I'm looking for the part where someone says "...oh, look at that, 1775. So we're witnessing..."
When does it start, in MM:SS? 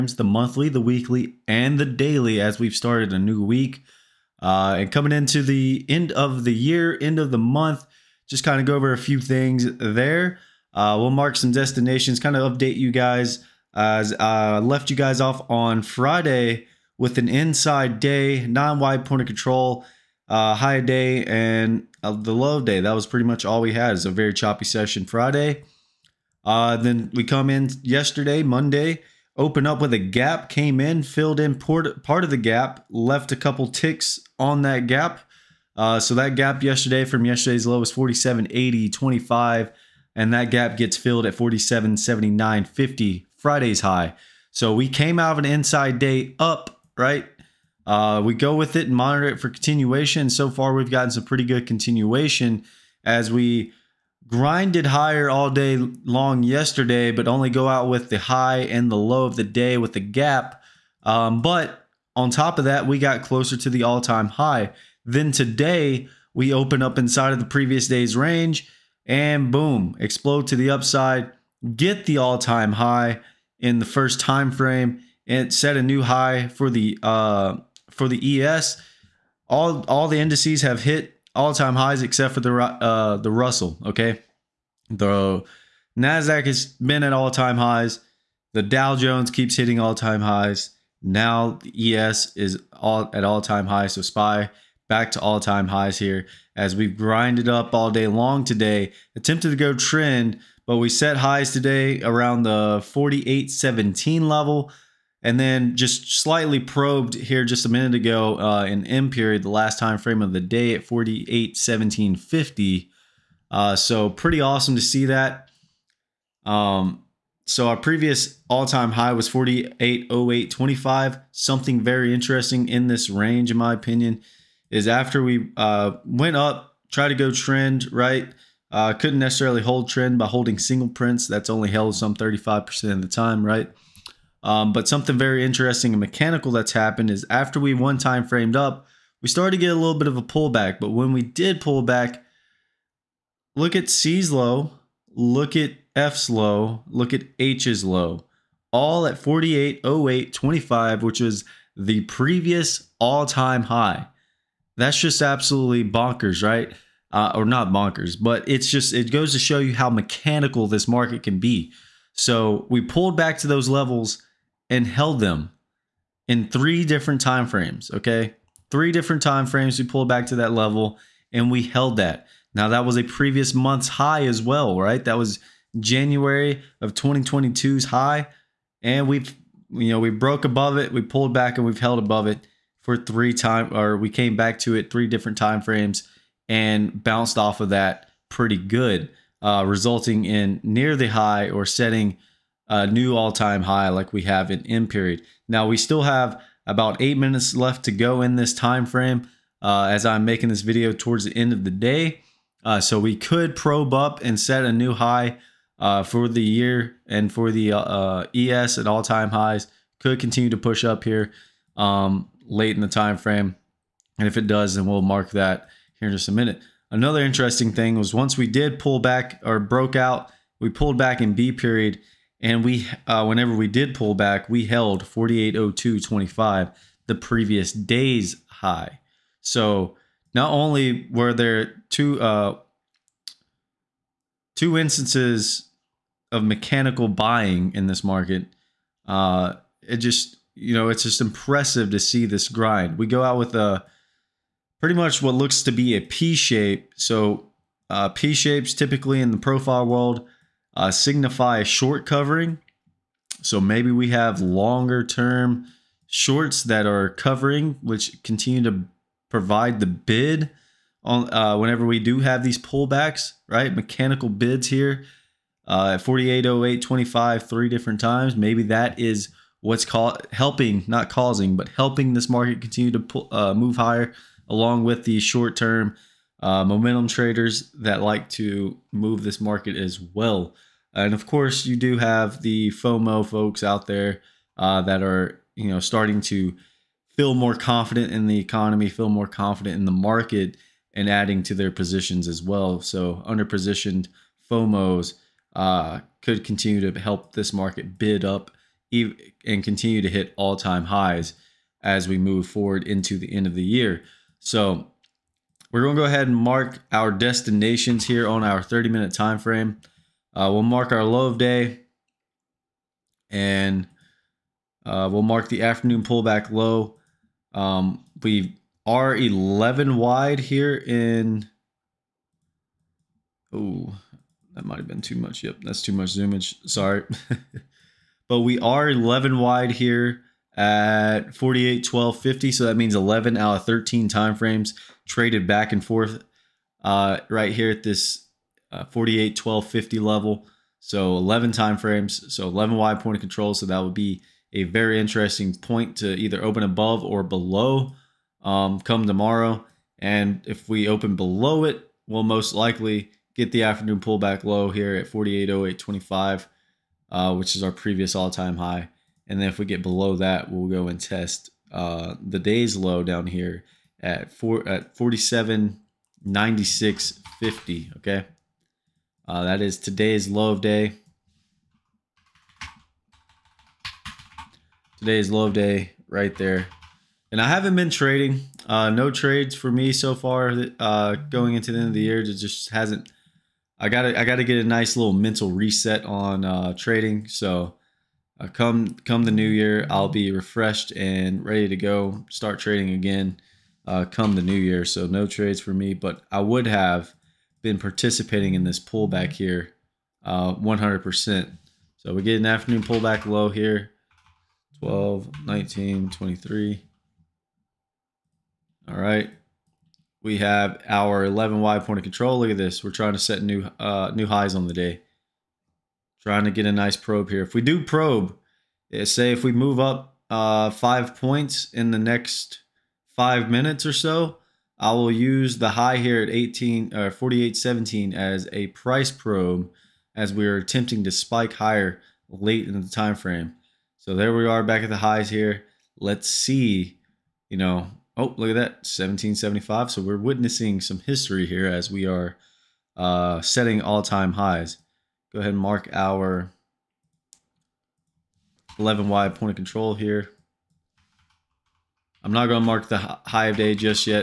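07:18.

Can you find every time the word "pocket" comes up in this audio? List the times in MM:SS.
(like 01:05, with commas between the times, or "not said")
not said.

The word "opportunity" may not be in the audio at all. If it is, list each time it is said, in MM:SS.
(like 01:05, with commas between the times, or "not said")
not said.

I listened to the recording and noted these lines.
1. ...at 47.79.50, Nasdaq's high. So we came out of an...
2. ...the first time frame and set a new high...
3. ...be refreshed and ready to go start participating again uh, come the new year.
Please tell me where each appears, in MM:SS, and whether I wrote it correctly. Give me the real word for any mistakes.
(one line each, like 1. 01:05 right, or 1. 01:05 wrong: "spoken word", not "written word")
1. 00:41 wrong: "Friday", not "Nasdaq"
2. 01:13 right
3. 06:30 wrong: "trading", not "participating".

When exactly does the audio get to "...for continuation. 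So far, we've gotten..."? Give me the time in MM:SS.
00:49.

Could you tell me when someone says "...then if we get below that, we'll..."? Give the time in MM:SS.
05:59.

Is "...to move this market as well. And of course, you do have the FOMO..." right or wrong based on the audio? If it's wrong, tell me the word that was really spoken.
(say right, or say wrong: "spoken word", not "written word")
right.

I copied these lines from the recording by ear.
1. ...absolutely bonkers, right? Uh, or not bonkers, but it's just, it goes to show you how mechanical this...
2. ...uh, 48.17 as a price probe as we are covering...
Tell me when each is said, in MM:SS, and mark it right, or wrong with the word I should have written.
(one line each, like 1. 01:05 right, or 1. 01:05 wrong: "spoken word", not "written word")
1. 02:35 right
2. 07:07 wrong: "attempting", not "covering".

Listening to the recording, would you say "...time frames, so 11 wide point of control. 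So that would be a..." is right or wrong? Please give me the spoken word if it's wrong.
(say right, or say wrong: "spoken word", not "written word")
right.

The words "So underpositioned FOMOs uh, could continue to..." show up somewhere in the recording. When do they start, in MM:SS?
04:52.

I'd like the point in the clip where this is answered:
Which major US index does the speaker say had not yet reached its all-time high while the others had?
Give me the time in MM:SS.
01:23.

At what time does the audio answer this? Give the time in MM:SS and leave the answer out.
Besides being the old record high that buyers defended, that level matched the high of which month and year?
02:55.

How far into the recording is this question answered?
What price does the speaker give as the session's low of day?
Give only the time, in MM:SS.
06:04.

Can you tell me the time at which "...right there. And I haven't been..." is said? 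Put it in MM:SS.
06:16.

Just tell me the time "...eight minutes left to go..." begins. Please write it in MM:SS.
03:17.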